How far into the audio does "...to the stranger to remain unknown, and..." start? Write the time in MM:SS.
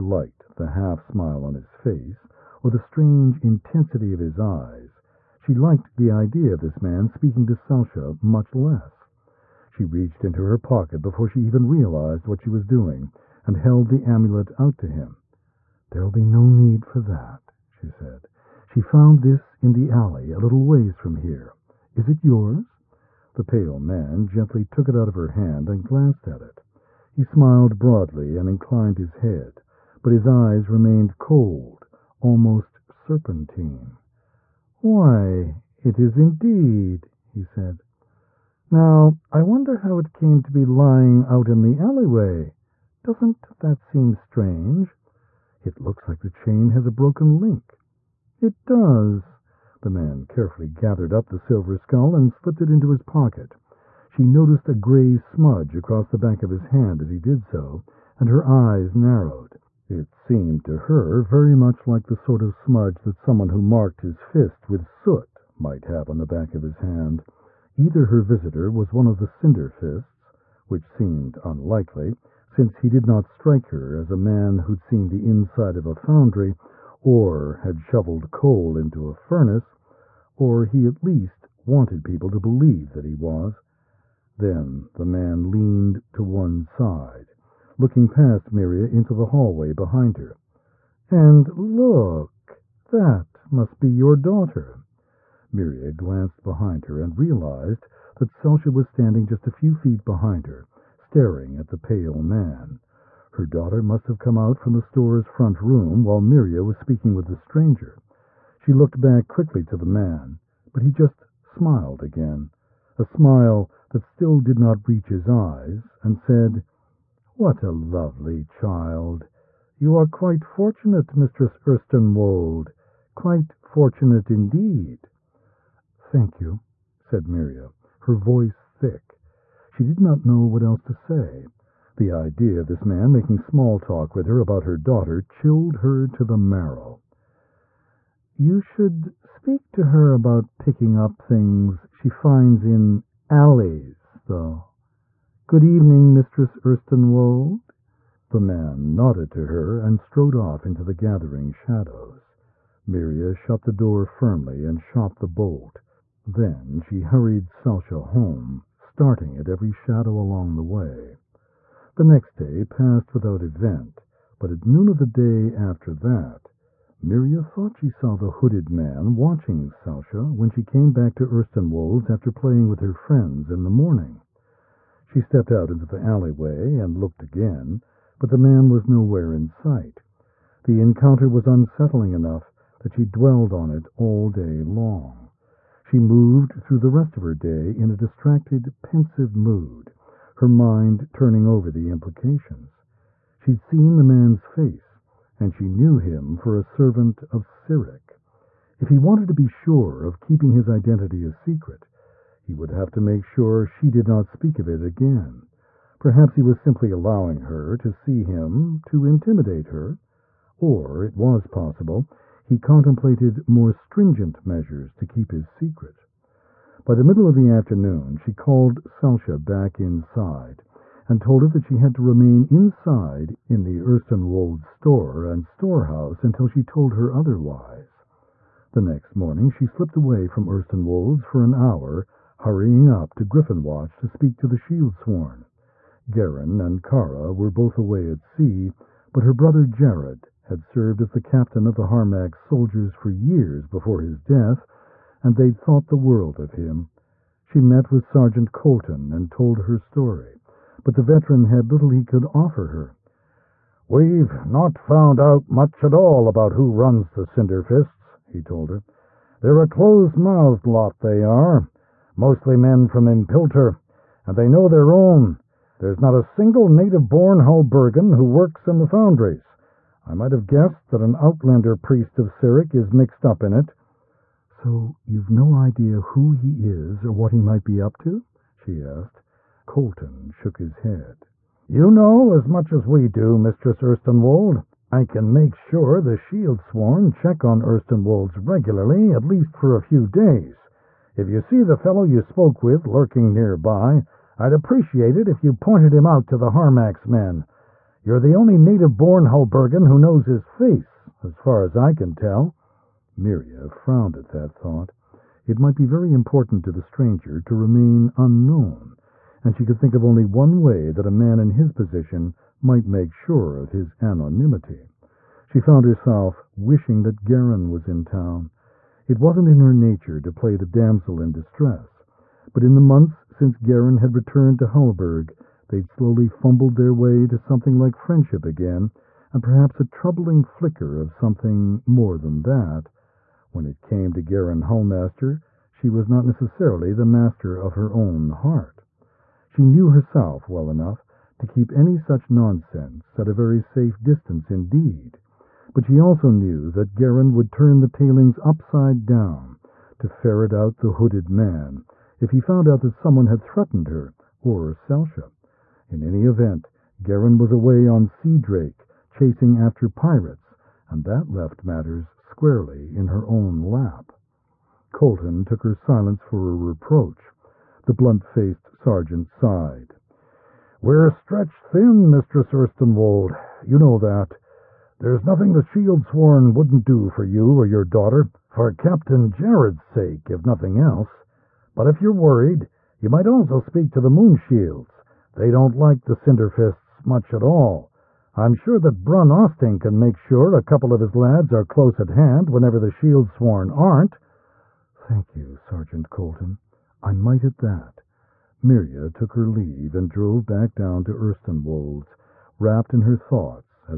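05:06.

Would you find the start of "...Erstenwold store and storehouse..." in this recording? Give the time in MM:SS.
03:43.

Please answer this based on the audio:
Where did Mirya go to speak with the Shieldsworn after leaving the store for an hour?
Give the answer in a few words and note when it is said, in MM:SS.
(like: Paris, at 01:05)
Griffonwatch, at 03:53.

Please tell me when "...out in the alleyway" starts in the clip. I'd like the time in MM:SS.
00:41.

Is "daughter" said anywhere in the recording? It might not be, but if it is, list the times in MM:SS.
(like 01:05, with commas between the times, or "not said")
01:34, 01:43, 02:14, 06:17.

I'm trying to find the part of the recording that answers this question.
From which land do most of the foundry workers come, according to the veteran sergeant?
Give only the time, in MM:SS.
04:23.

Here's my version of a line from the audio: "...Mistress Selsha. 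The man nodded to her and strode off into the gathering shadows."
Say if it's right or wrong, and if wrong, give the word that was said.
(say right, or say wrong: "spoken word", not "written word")
wrong: "Erstenwold", not "Selsha".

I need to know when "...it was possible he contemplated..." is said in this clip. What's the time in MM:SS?
03:31.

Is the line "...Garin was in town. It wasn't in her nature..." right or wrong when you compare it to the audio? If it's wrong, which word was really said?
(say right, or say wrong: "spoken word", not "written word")
right.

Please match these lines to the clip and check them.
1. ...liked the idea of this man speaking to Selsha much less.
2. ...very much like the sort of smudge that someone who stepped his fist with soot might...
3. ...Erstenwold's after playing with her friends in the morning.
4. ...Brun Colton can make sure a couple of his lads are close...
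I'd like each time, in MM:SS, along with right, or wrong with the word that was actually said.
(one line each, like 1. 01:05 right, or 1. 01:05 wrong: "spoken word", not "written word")
1. 00:05 right
2. 01:01 wrong: "marked", not "stepped"
3. 02:51 right
4. 06:29 wrong: "Osting", not "Colton".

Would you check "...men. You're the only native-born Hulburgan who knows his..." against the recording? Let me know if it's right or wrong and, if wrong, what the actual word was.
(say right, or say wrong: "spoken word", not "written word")
right.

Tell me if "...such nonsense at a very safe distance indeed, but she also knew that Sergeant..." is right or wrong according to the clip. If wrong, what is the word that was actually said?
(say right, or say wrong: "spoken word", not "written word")
wrong: "Garin", not "Sergeant".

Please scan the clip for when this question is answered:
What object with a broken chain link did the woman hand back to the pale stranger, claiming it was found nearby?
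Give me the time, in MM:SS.
00:14.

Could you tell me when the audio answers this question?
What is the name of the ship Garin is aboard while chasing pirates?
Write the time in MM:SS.
05:58.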